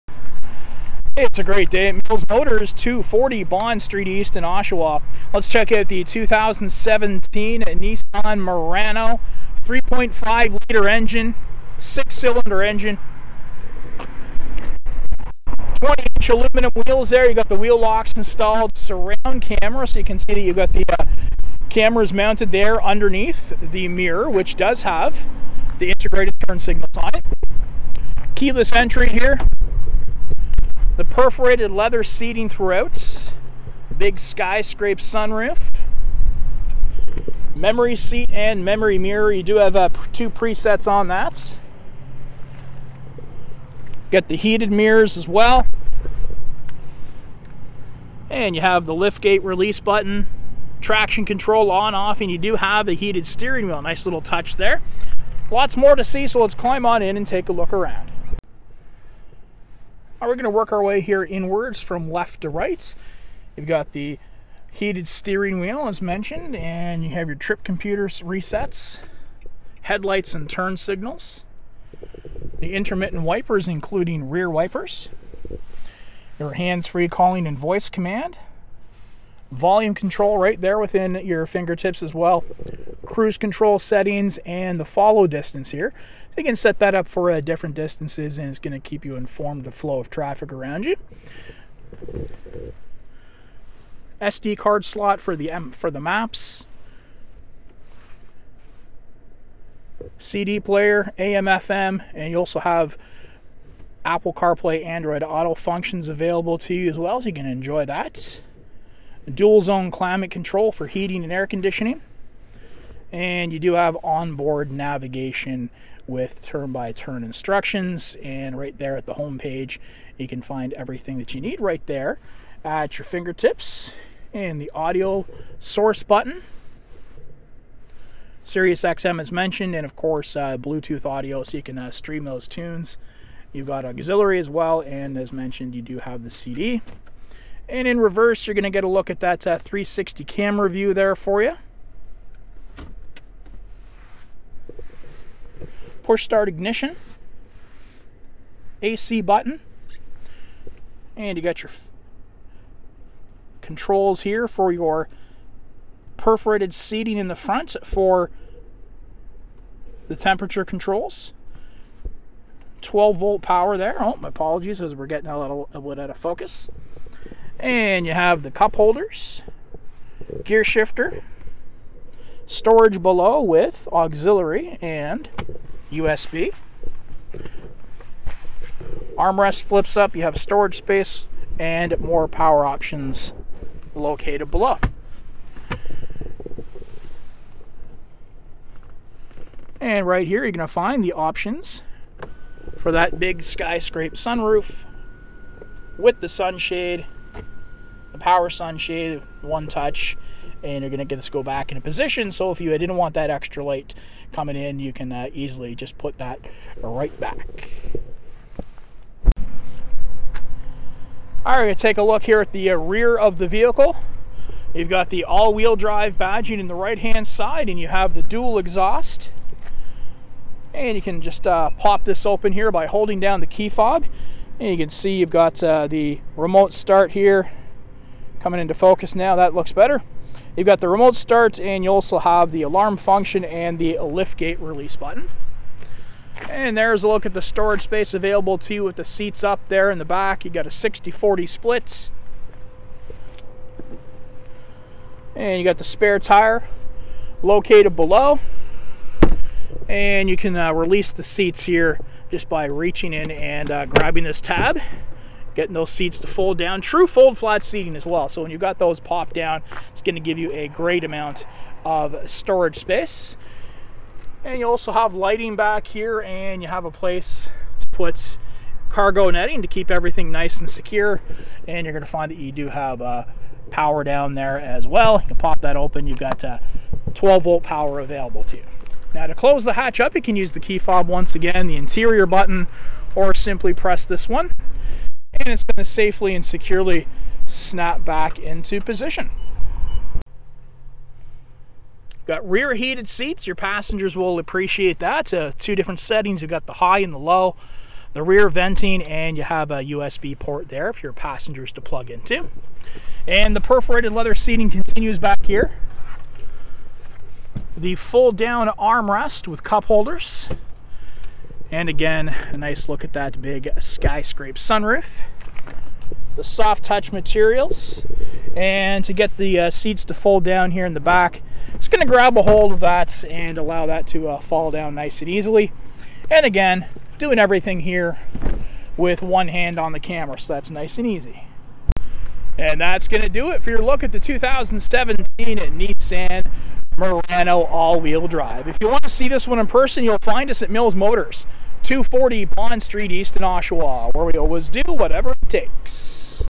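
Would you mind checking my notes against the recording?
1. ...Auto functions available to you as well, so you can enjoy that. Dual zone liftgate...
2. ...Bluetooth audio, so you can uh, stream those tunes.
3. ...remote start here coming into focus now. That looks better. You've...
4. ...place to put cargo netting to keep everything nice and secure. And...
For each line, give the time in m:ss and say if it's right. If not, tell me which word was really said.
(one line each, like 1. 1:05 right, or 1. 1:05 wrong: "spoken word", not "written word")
1. 1:45 wrong: "climate", not "liftgate"
2. 2:10 right
3. 3:46 right
4. 4:26 right.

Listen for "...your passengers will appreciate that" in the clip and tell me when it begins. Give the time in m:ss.
4:53.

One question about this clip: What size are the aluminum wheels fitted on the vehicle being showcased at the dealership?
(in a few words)
20 inch.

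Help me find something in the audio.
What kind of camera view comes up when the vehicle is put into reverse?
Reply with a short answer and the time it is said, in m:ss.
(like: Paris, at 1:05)
360 camera view, at 2:19.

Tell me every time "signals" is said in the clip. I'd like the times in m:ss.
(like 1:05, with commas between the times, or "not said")
0:26, 1:10.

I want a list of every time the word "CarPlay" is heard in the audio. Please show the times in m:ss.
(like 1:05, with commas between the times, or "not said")
1:44.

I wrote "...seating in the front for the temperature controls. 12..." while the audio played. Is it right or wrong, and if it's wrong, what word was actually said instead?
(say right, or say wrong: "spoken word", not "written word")
right.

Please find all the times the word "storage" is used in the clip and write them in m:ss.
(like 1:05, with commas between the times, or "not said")
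2:52, 3:00, 3:57, 4:22.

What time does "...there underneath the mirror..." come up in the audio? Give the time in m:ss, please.
0:22.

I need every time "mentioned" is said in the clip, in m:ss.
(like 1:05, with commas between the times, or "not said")
1:05, 2:09, 2:15.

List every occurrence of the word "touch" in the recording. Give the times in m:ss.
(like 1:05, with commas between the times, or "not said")
0:54, 3:19, 5:16.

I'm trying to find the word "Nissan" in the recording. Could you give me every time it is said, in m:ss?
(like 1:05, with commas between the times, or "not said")
0:07, 5:35.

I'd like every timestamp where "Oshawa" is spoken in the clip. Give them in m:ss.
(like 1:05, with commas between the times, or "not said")
0:04, 5:43.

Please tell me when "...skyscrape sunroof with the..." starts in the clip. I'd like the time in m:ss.
3:13.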